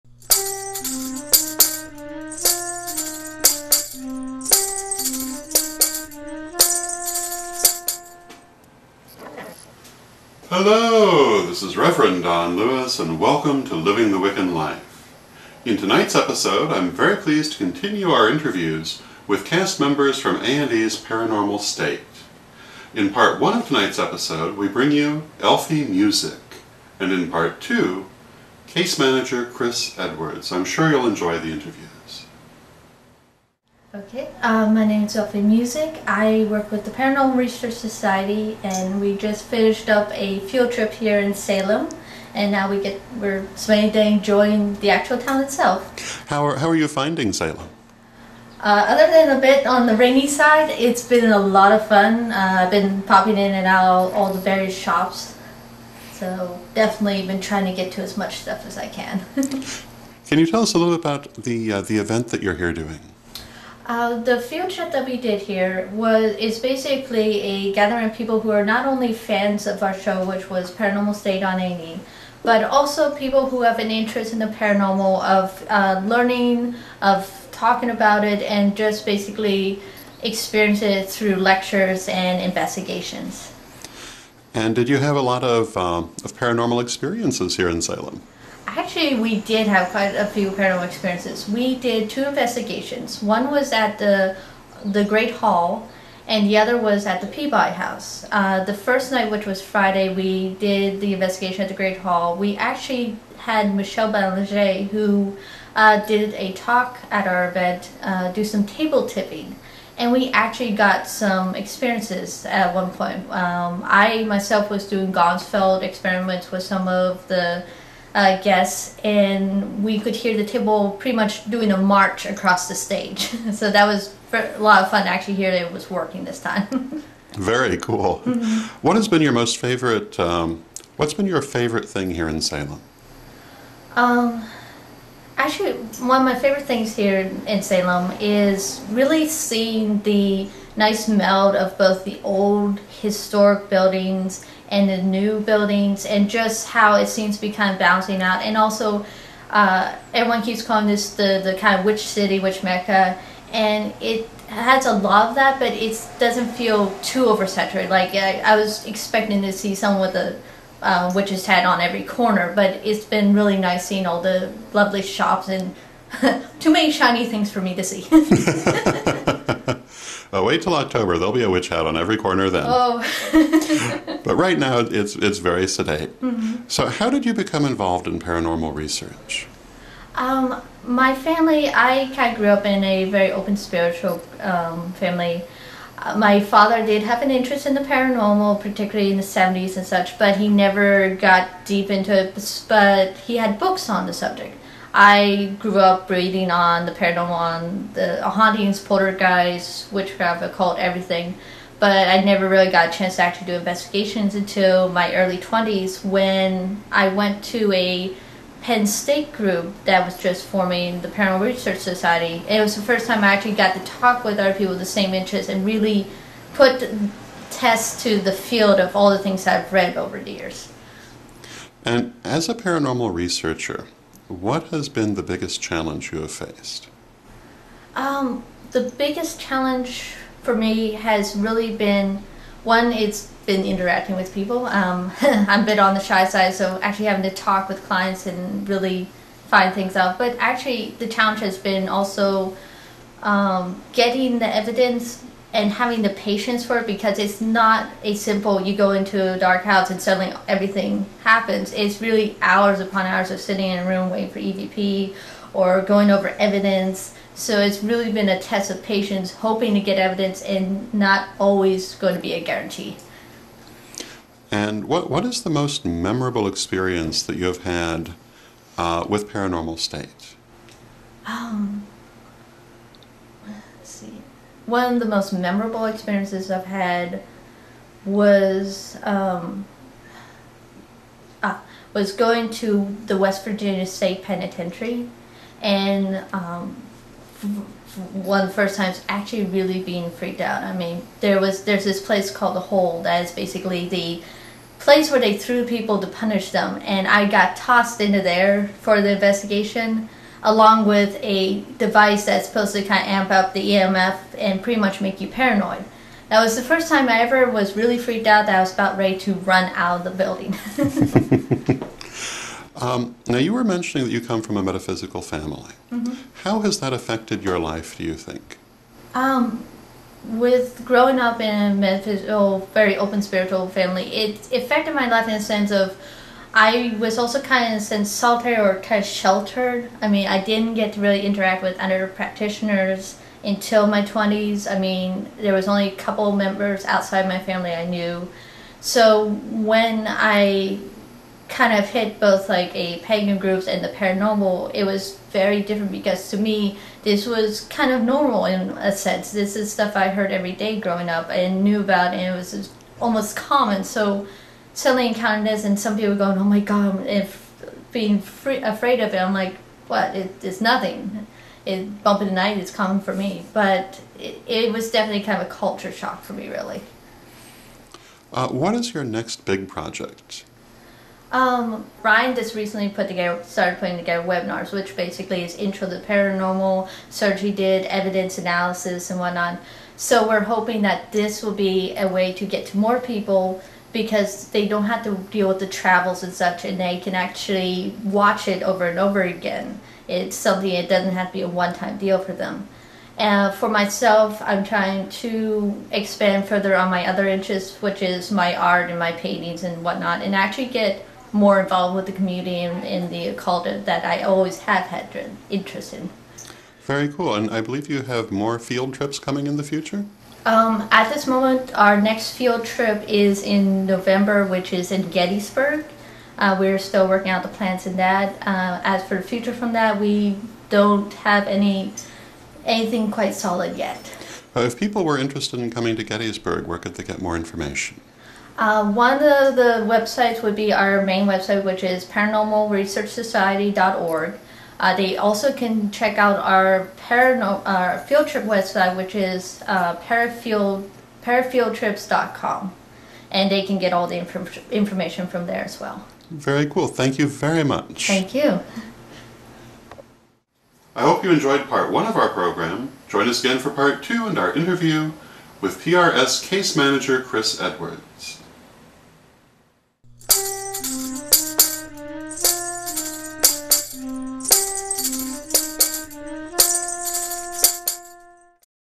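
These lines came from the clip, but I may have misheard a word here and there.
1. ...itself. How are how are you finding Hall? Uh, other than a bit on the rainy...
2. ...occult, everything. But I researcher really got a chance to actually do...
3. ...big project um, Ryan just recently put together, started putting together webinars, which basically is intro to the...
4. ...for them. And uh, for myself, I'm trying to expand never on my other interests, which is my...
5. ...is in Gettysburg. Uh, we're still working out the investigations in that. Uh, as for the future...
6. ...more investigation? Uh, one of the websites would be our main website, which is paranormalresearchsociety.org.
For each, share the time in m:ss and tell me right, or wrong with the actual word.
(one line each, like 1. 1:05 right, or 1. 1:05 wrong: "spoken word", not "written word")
1. 0:45 wrong: "Salem", not "Hall"
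2. 3:20 wrong: "never", not "researcher"
3. 6:09 right
4. 6:32 wrong: "further", not "never"
5. 6:54 wrong: "plans", not "investigations"
6. 7:07 wrong: "information", not "investigation".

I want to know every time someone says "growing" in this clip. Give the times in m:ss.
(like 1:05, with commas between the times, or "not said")
5:20, 5:50.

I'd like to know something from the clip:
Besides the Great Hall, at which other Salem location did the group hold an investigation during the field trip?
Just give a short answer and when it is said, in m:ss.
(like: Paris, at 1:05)
Peabody House, at 1:37.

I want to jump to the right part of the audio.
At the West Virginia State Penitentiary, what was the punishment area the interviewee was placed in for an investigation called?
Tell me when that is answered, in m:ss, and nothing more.
4:52.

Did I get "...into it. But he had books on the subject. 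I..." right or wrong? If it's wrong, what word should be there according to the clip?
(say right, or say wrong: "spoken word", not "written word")
right.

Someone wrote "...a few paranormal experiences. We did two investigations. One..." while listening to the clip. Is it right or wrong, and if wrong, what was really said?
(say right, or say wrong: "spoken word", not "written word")
right.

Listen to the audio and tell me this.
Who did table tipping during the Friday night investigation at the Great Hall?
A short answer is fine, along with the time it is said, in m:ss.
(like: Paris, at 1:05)
Michelle Belanger, at 1:43.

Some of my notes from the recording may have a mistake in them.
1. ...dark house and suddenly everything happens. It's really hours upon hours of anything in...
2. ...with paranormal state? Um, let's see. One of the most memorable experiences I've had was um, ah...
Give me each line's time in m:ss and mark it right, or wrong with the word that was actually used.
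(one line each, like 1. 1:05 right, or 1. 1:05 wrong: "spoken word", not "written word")
1. 4:09 wrong: "sitting", not "anything"
2. 4:29 right.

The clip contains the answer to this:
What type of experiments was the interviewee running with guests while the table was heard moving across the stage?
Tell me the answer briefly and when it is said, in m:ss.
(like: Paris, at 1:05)
Ganzfeld experiments, at 1:55.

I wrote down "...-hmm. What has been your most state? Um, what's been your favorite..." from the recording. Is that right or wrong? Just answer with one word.
wrong.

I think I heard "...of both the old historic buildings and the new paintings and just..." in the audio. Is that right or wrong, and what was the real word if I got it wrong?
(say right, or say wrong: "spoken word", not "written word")
wrong: "buildings", not "paintings".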